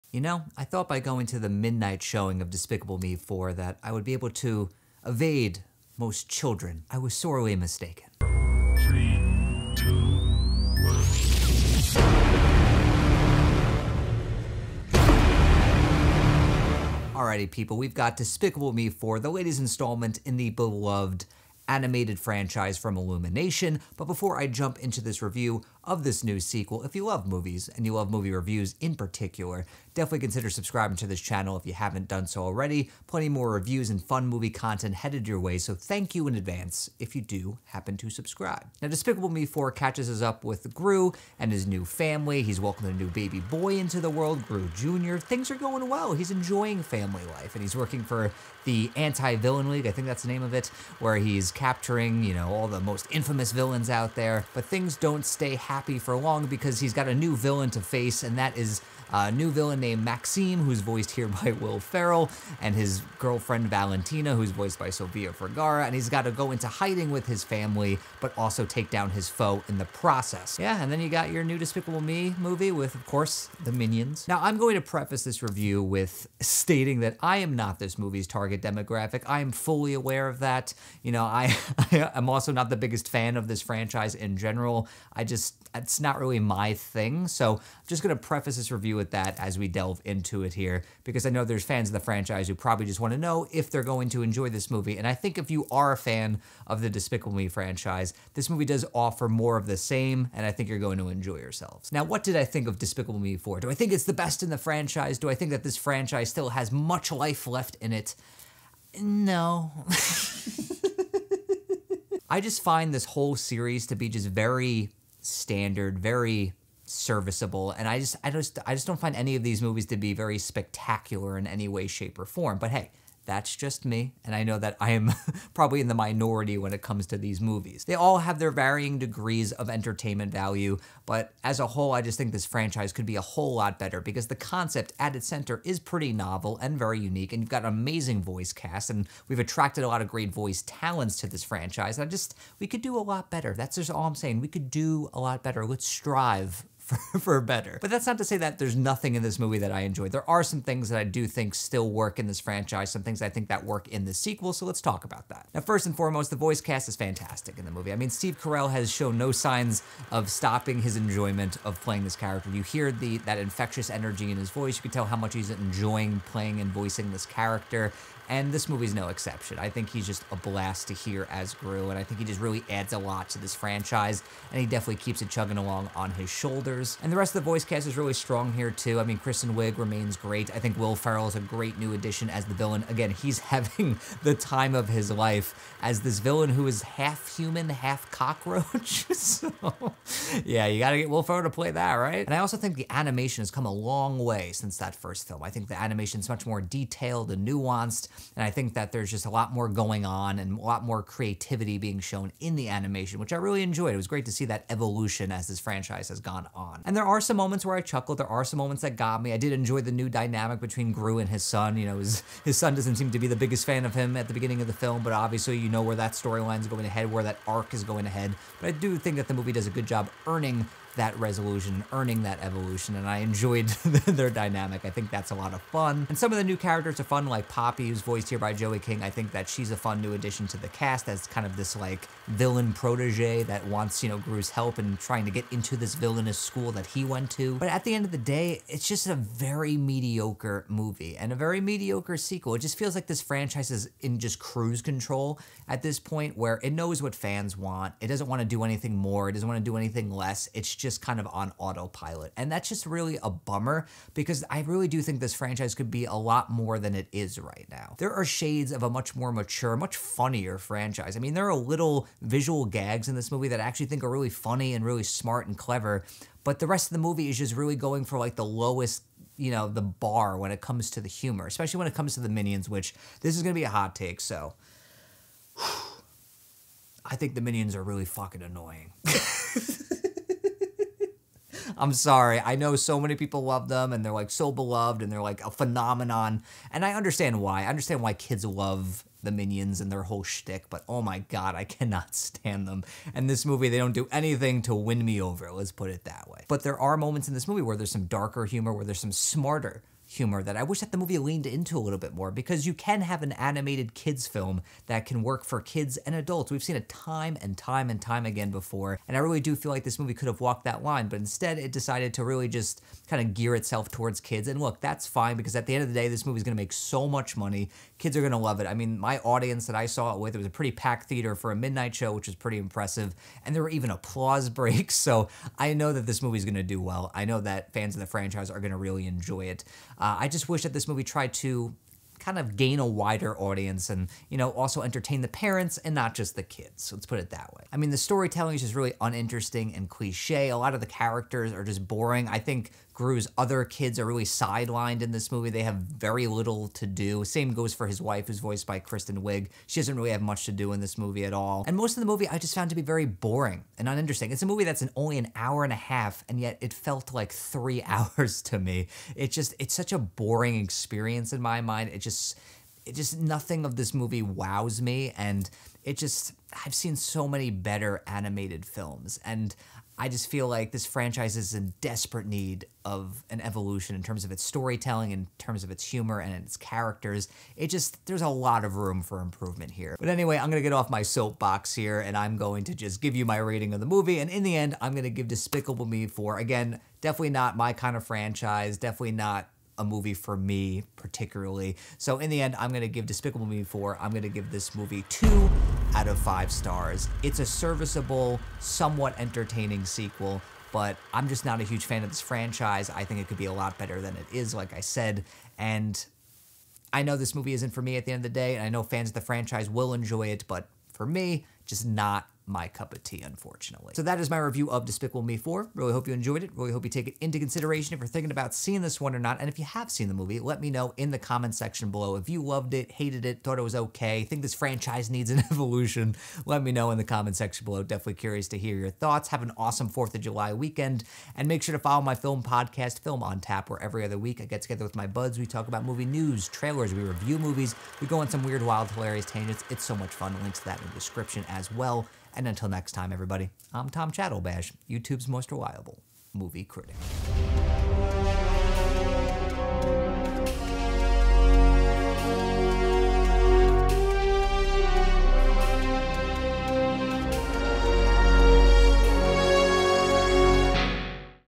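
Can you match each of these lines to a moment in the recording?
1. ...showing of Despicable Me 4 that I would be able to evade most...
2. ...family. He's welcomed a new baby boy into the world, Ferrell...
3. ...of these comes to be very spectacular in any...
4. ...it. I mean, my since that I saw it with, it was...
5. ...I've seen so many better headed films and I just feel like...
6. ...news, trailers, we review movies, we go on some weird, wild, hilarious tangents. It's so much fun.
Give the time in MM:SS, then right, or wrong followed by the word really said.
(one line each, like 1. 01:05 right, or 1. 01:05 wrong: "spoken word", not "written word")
1. 00:02 right
2. 00:41 wrong: "Gru", not "Ferrell"
3. 01:59 wrong: "movies", not "comes"
4. 05:18 wrong: "audience", not "since"
5. 06:06 wrong: "animated", not "headed"
6. 07:16 right.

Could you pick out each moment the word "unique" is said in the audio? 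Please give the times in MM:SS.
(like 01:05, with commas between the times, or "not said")
02:16.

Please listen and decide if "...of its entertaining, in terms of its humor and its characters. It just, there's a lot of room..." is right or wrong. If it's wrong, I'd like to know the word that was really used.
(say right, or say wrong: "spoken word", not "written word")
wrong: "storytelling", not "entertaining".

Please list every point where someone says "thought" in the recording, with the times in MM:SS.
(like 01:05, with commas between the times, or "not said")
00:00, 07:03, 07:08.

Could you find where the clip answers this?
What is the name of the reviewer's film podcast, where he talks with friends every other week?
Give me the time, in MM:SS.
07:13.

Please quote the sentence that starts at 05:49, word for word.
She doesn't really have much to do in this movie at all.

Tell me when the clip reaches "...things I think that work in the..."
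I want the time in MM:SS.
02:33.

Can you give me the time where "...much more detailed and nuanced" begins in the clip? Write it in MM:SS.
03:16.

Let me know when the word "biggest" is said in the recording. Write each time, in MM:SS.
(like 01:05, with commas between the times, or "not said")
01:22, 03:33.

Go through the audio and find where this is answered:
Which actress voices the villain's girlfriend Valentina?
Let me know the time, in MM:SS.
01:04.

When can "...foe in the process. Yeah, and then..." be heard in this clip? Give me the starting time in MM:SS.
01:09.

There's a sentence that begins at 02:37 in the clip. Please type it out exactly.
I mean, Steve Carell has shown no signs of stopping his enjoyment of playing this character.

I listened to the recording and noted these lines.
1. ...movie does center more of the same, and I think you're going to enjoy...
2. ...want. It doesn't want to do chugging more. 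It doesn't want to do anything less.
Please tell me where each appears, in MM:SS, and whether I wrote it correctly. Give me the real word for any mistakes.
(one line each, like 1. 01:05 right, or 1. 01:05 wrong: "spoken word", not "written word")
1. 01:38 wrong: "offer", not "center"
2. 04:07 wrong: "anything", not "chugging".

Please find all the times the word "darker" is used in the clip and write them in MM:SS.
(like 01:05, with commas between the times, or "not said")
04:58.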